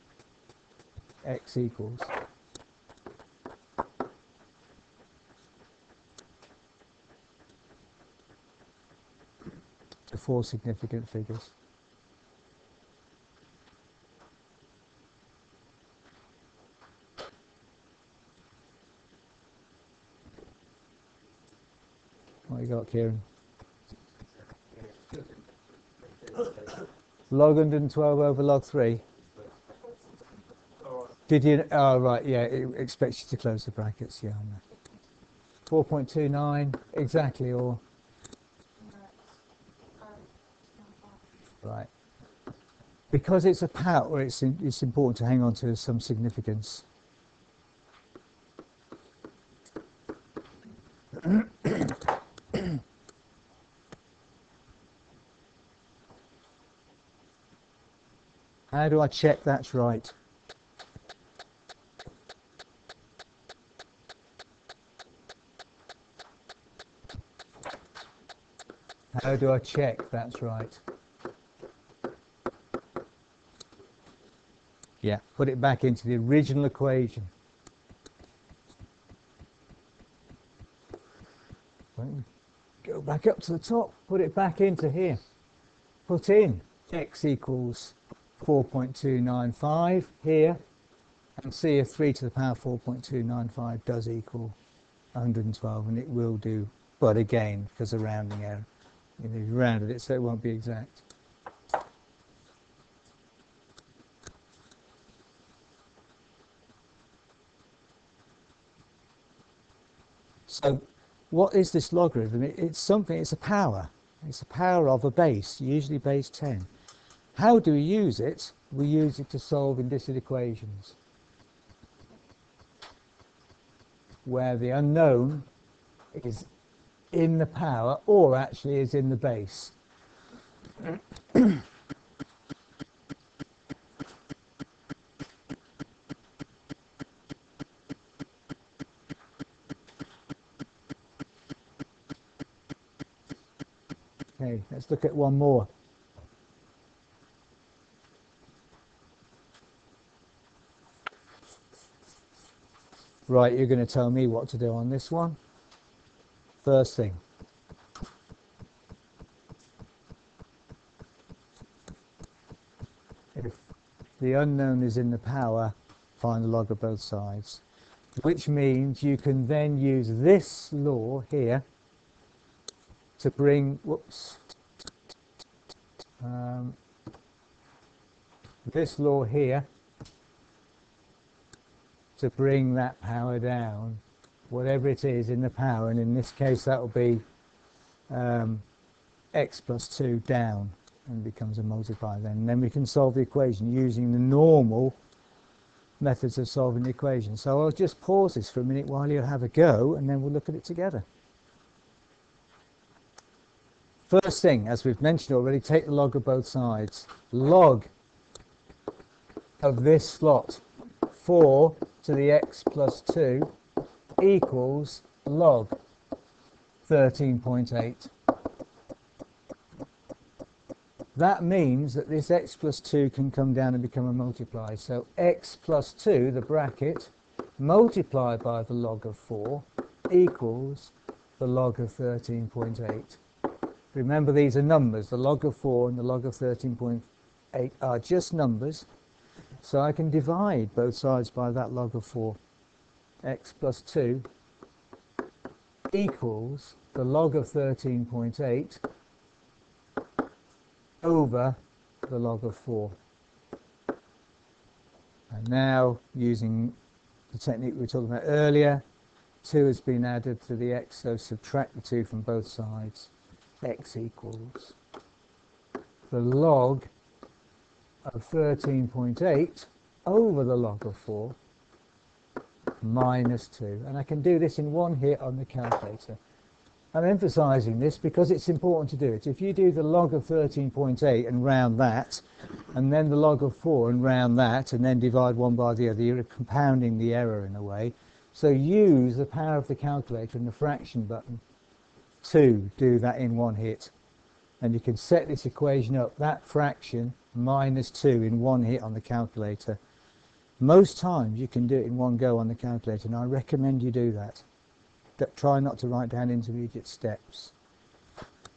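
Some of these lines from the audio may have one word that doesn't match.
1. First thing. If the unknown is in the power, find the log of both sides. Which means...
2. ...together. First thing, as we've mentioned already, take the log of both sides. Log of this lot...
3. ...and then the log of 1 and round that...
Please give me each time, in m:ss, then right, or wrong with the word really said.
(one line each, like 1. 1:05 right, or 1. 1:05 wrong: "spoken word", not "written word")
1. 2:36 right
2. 3:20 right
3. 4:42 wrong: "4", not "1".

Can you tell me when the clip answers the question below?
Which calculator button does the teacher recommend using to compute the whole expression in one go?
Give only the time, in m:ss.
4:50.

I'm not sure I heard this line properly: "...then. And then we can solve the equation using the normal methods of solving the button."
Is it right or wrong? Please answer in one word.
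wrong.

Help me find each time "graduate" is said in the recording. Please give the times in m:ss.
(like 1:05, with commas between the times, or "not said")
not said.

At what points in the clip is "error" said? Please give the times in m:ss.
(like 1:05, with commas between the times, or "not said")
1:38, 4:47.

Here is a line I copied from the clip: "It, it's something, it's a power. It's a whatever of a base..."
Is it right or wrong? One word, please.
wrong.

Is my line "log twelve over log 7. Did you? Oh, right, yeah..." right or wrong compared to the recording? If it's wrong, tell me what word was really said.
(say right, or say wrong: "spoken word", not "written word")
wrong: "3", not "7".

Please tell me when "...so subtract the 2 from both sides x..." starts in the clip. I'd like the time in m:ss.
4:20.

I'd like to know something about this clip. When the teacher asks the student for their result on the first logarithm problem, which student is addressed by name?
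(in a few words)
Kieran.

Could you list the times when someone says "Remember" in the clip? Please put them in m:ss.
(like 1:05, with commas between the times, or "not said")
3:53.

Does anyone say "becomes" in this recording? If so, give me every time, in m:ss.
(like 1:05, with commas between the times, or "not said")
3:11, 3:43.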